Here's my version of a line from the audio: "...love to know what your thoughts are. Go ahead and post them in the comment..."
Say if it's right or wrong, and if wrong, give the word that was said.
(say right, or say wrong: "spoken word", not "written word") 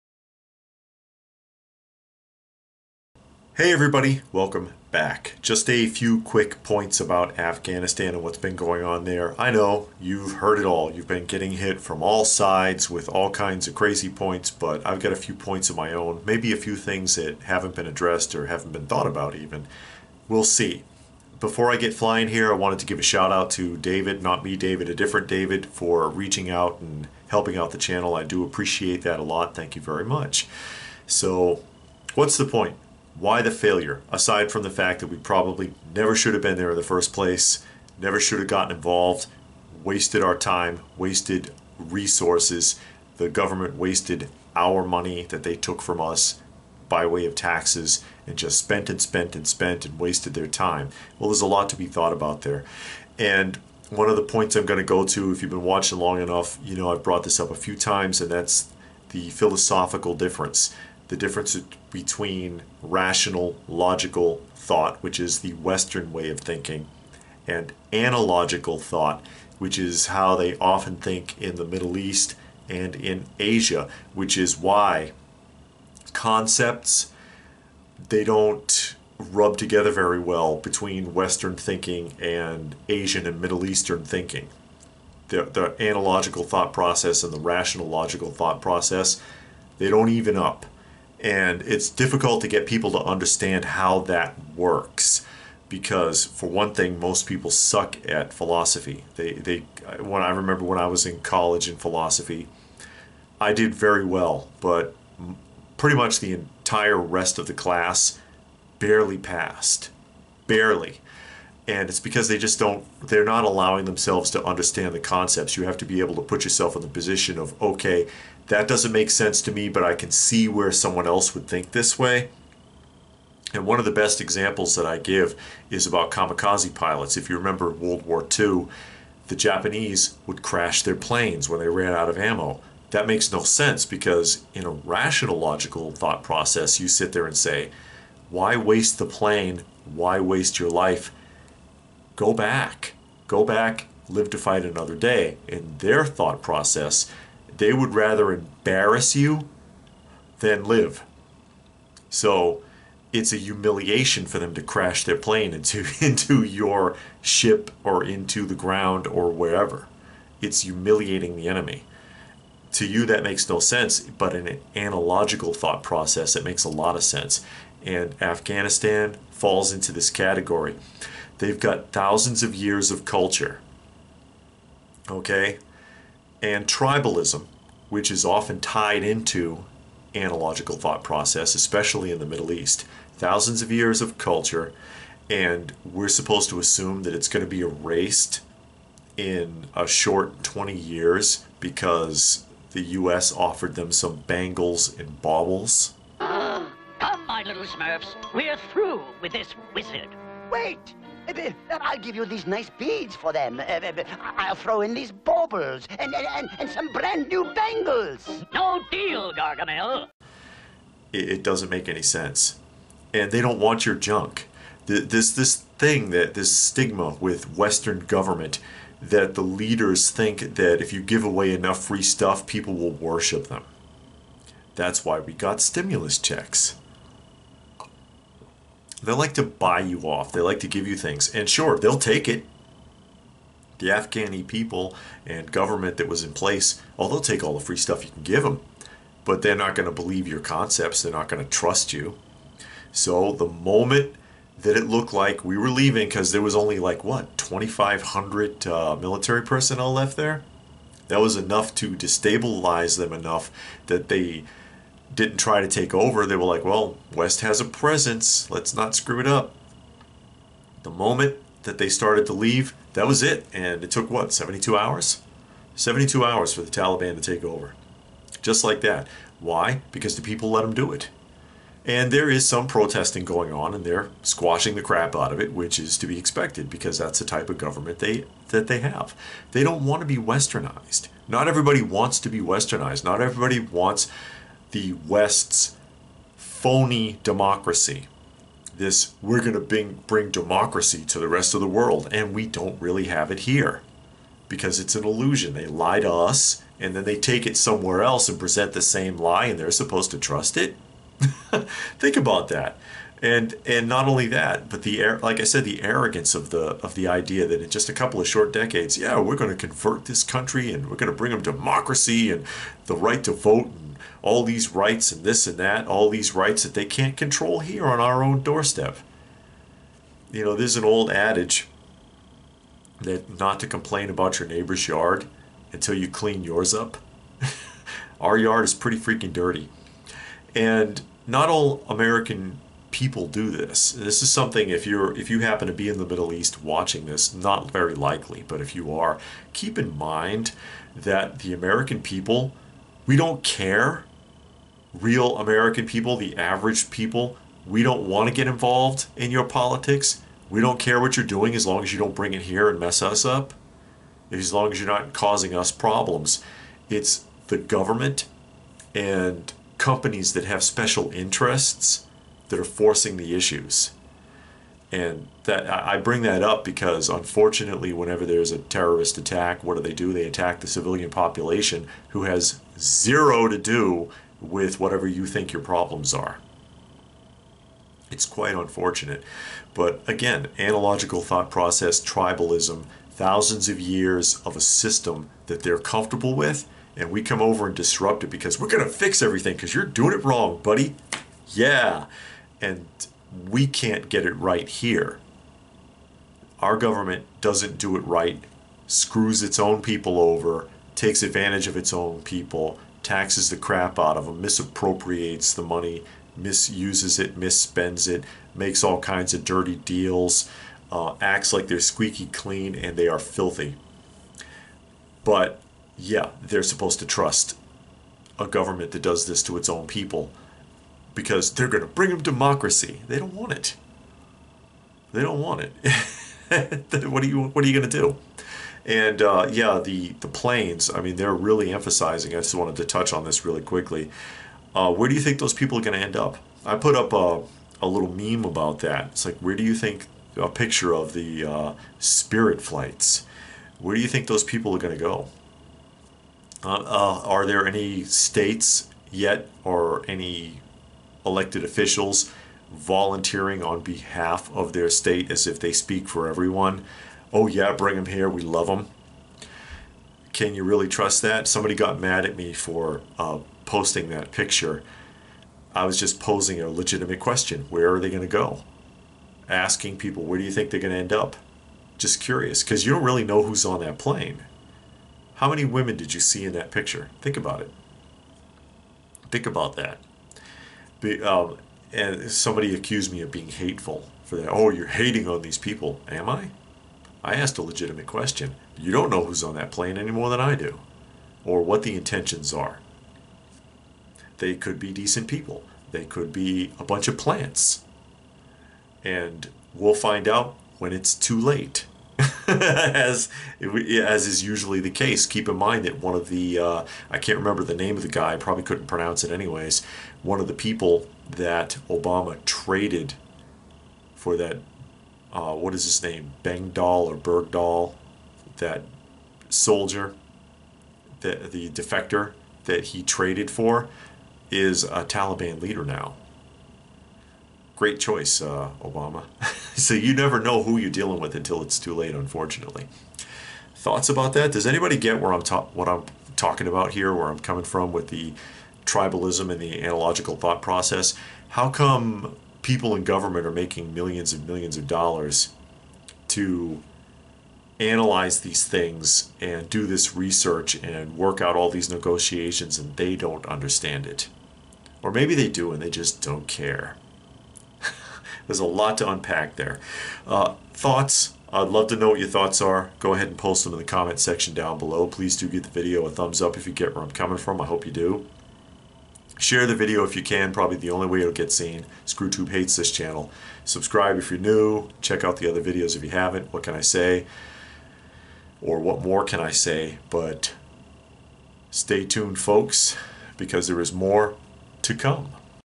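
right.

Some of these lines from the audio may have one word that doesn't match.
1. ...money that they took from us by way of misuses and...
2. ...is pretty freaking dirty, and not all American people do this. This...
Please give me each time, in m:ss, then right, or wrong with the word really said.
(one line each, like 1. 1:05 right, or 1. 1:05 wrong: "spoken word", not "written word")
1. 0:44 wrong: "taxes", not "misuses"
2. 5:28 right.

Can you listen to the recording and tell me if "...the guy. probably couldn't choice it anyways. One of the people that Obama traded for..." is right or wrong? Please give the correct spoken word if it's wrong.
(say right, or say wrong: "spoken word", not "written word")
wrong: "pronounce", not "choice".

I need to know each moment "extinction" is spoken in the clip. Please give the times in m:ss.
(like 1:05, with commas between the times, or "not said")
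not said.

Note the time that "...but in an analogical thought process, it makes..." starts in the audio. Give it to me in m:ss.
2:43.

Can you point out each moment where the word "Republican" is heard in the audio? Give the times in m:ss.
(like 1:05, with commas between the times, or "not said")
not said.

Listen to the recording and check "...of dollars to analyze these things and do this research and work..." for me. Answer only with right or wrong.
right.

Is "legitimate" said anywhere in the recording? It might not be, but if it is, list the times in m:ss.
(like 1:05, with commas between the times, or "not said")
7:46, 8:07.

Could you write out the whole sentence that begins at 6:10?
They attack the civilian population who has zero to do with whatever you think your problems are.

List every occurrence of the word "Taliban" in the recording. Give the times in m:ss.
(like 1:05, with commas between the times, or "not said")
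4:26, 8:45.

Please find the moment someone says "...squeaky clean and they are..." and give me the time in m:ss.
6:51.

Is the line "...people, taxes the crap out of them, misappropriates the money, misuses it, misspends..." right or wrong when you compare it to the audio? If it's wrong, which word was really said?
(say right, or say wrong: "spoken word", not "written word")
right.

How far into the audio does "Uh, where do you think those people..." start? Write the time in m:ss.
7:14.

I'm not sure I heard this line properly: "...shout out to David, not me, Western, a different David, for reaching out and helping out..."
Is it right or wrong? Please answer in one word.
wrong.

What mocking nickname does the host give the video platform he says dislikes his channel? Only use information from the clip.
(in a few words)
ScrewTube.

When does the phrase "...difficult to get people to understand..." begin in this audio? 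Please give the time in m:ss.
1:31.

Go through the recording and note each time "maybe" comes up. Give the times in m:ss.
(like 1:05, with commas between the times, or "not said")
0:16, 9:15.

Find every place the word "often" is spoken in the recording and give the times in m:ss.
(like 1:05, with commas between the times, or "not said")
1:10, 2:58.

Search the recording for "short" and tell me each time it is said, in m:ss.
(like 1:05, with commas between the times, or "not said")
3:09, 5:08.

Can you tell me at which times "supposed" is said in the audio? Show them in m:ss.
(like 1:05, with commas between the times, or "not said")
3:06, 4:59, 6:56.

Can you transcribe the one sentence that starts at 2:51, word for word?
They've got thousands of years of culture.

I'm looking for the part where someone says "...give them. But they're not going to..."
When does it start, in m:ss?
3:58.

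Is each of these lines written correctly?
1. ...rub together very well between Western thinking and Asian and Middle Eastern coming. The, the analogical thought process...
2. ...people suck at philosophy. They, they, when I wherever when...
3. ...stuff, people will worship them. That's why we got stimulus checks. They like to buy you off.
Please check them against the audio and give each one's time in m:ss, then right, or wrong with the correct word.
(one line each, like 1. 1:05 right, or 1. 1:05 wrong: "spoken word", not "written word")
1. 1:19 wrong: "thinking", not "coming"
2. 1:37 wrong: "remember", not "wherever"
3. 3:42 right.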